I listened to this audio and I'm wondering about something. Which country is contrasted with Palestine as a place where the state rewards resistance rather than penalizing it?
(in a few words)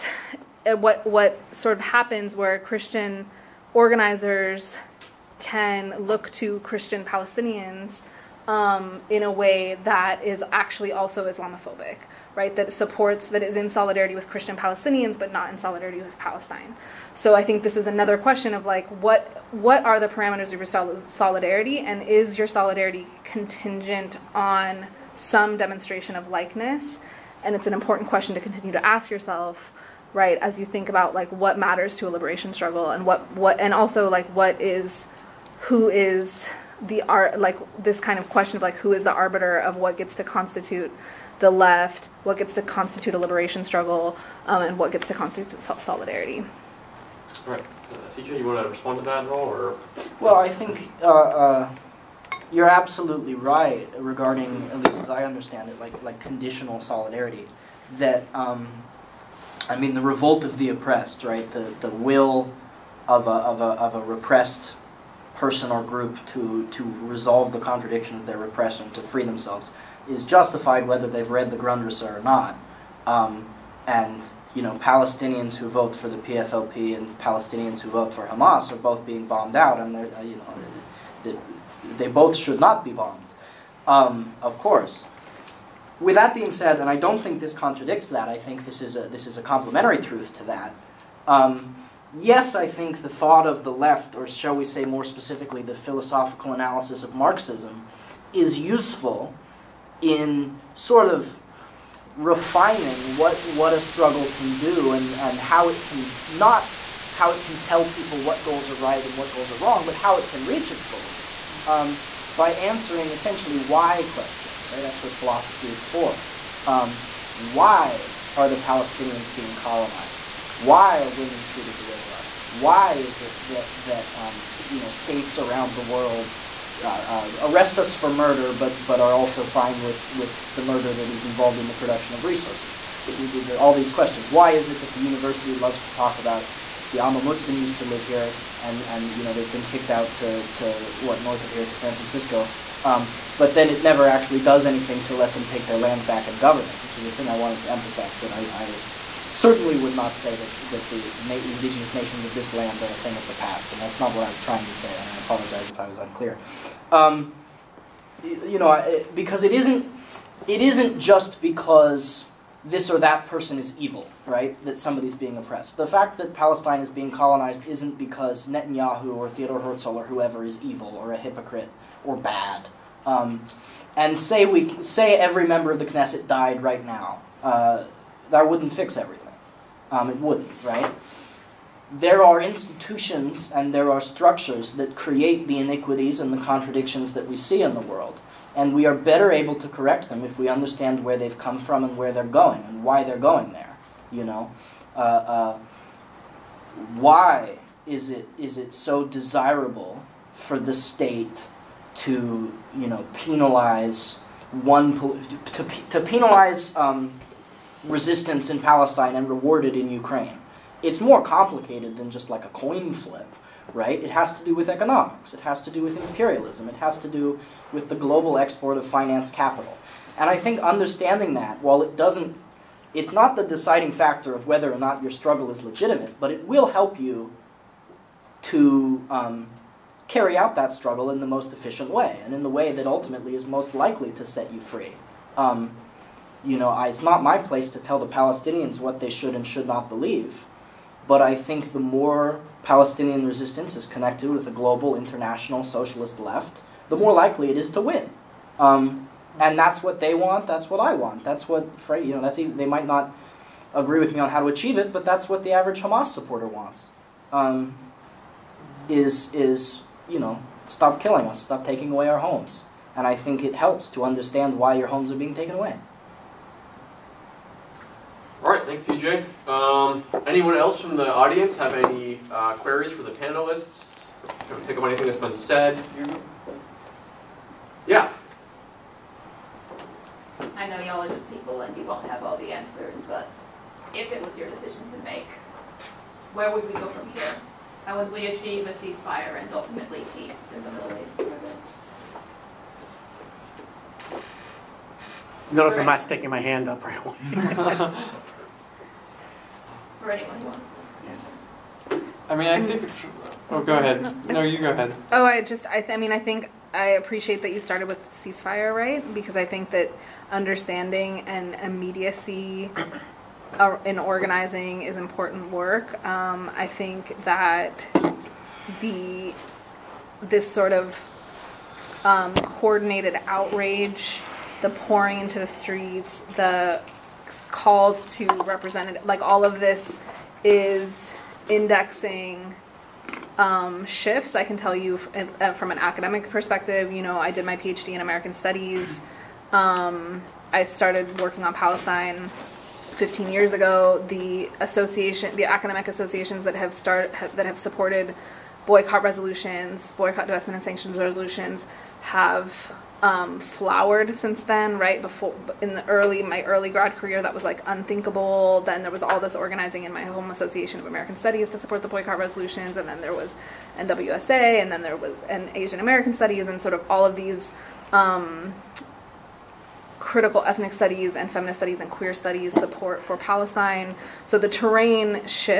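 Ukraine.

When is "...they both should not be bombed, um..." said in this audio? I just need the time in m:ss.
1:21.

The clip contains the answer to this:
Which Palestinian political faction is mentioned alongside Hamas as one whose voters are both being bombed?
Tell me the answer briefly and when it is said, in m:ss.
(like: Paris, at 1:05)
PFLP, at 1:16.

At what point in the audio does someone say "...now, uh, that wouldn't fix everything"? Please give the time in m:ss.
2:56.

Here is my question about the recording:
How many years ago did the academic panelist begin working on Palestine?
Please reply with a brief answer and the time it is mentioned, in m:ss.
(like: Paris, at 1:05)
15 years, at 5:42.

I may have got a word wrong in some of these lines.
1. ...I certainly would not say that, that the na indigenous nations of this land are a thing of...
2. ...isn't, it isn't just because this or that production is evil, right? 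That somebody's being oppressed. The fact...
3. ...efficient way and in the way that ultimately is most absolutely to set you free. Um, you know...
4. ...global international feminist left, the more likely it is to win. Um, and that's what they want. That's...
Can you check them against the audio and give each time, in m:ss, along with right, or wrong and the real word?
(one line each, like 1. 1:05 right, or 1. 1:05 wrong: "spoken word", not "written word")
1. 2:28 right
2. 2:39 wrong: "person", not "production"
3. 3:51 wrong: "likely", not "absolutely"
4. 4:04 wrong: "socialist", not "feminist".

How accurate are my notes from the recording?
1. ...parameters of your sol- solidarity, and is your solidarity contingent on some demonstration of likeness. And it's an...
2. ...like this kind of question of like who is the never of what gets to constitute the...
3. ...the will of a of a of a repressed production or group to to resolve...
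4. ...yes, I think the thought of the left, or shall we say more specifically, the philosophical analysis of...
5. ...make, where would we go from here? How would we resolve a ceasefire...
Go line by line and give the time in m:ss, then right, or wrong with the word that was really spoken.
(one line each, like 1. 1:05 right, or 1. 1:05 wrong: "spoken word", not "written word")
1. 0:20 right
2. 0:37 wrong: "arbiter", not "never"
3. 1:01 wrong: "person", not "production"
4. 1:32 right
5. 4:44 wrong: "achieve", not "resolve".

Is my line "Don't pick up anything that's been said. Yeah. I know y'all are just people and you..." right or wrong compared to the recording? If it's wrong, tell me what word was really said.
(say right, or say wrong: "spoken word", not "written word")
right.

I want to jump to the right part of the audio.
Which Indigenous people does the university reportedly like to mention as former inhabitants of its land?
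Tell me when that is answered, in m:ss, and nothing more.
2:17.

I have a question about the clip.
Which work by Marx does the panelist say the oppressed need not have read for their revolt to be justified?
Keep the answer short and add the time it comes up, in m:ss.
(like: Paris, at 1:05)
Grundrisse, at 1:11.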